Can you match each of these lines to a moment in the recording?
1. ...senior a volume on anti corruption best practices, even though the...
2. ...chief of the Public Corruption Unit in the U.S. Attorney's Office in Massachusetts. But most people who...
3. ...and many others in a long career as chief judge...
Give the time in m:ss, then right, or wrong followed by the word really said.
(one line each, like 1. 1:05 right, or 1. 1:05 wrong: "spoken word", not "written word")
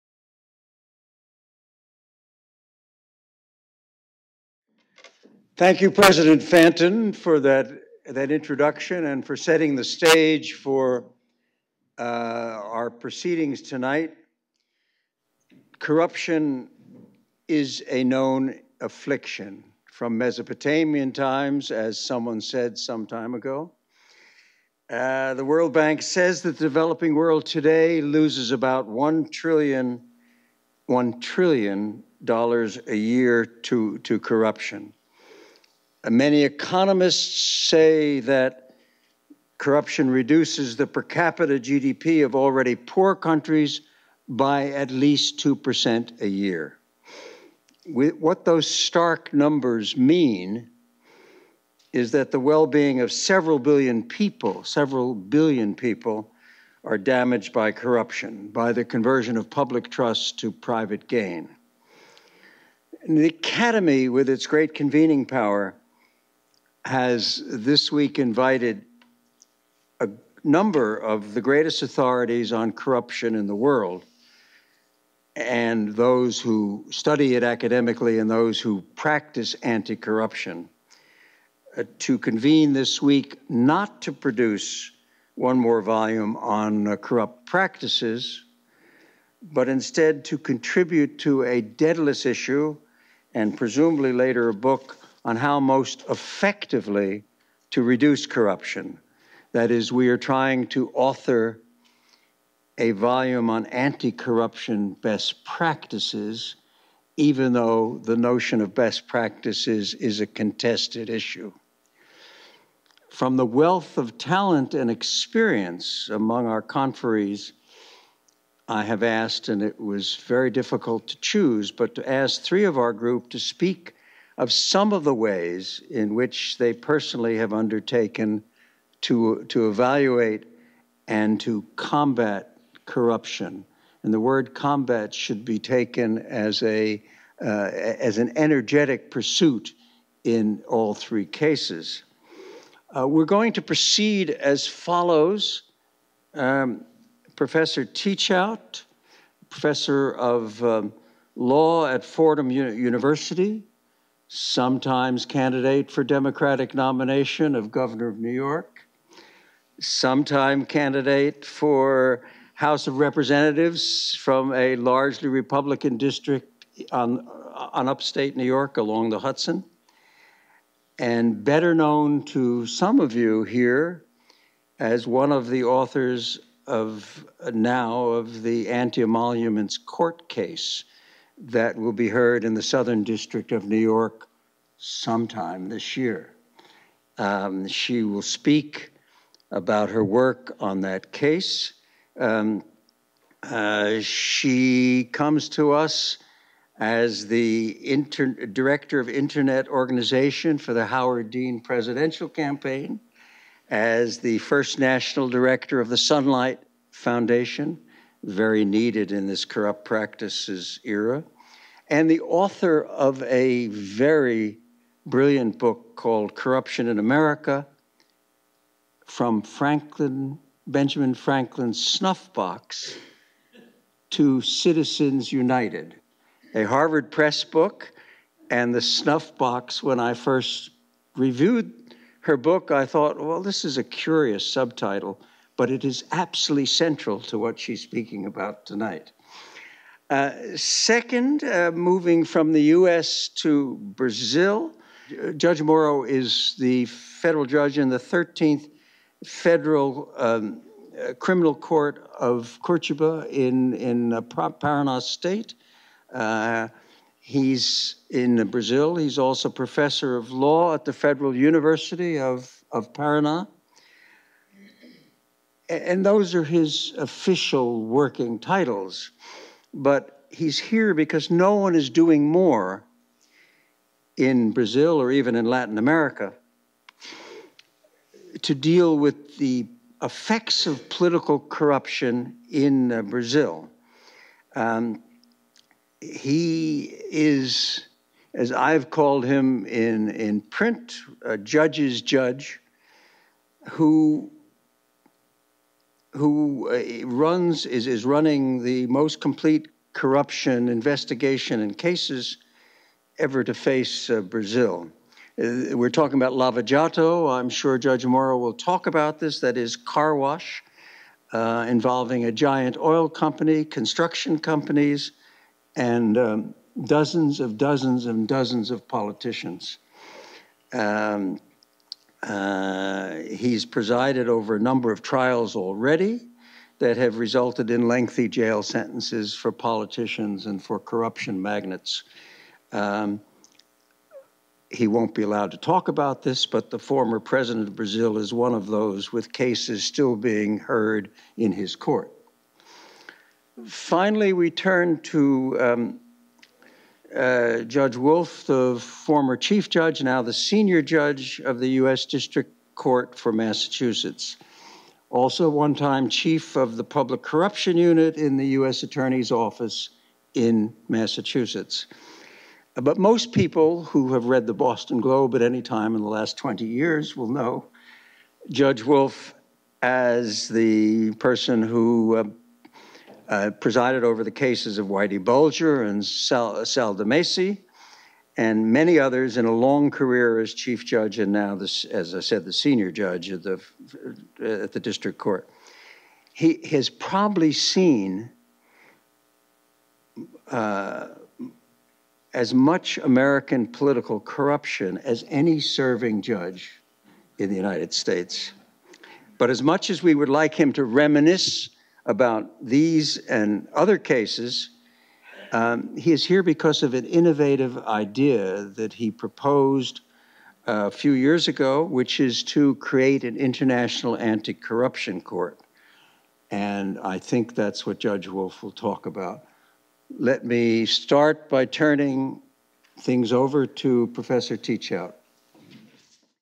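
1. 1:40 wrong: "author", not "senior"
2. 5:56 right
3. 6:18 right.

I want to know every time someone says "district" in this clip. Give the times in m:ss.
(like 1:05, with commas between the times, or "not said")
2:45, 3:03, 5:52, 6:24.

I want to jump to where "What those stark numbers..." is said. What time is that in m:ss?
0:47.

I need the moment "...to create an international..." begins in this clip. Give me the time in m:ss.
6:52.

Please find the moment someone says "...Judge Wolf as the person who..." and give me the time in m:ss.
6:08.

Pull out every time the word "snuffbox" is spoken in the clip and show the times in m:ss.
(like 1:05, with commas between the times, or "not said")
3:41, 3:48.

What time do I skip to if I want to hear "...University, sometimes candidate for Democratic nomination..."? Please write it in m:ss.
2:32.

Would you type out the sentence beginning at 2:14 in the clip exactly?
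And the word combat should be taken as, a, uh, as an energetic pursuit in all three cases.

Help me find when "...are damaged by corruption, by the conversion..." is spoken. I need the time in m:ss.
0:56.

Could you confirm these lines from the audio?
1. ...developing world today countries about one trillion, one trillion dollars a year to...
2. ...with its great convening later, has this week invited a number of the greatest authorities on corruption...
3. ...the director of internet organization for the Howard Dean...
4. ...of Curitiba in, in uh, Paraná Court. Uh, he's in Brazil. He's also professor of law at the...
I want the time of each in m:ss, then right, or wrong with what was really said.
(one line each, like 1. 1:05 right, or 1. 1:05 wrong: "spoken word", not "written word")
1. 0:26 wrong: "loses", not "countries"
2. 1:04 wrong: "power", not "later"
3. 3:17 right
4. 4:12 wrong: "State", not "Court".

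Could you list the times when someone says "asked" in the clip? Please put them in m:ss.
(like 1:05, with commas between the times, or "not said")
1:59.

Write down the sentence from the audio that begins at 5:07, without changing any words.
I'm sure Judge Moro will talk about this.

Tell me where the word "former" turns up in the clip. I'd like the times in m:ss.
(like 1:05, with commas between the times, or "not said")
5:36, 5:48.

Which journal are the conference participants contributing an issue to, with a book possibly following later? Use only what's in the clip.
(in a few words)
Dædalus.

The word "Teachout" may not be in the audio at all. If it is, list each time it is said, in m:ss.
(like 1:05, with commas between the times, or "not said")
2:27, 7:04.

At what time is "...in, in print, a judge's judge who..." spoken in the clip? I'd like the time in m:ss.
4:49.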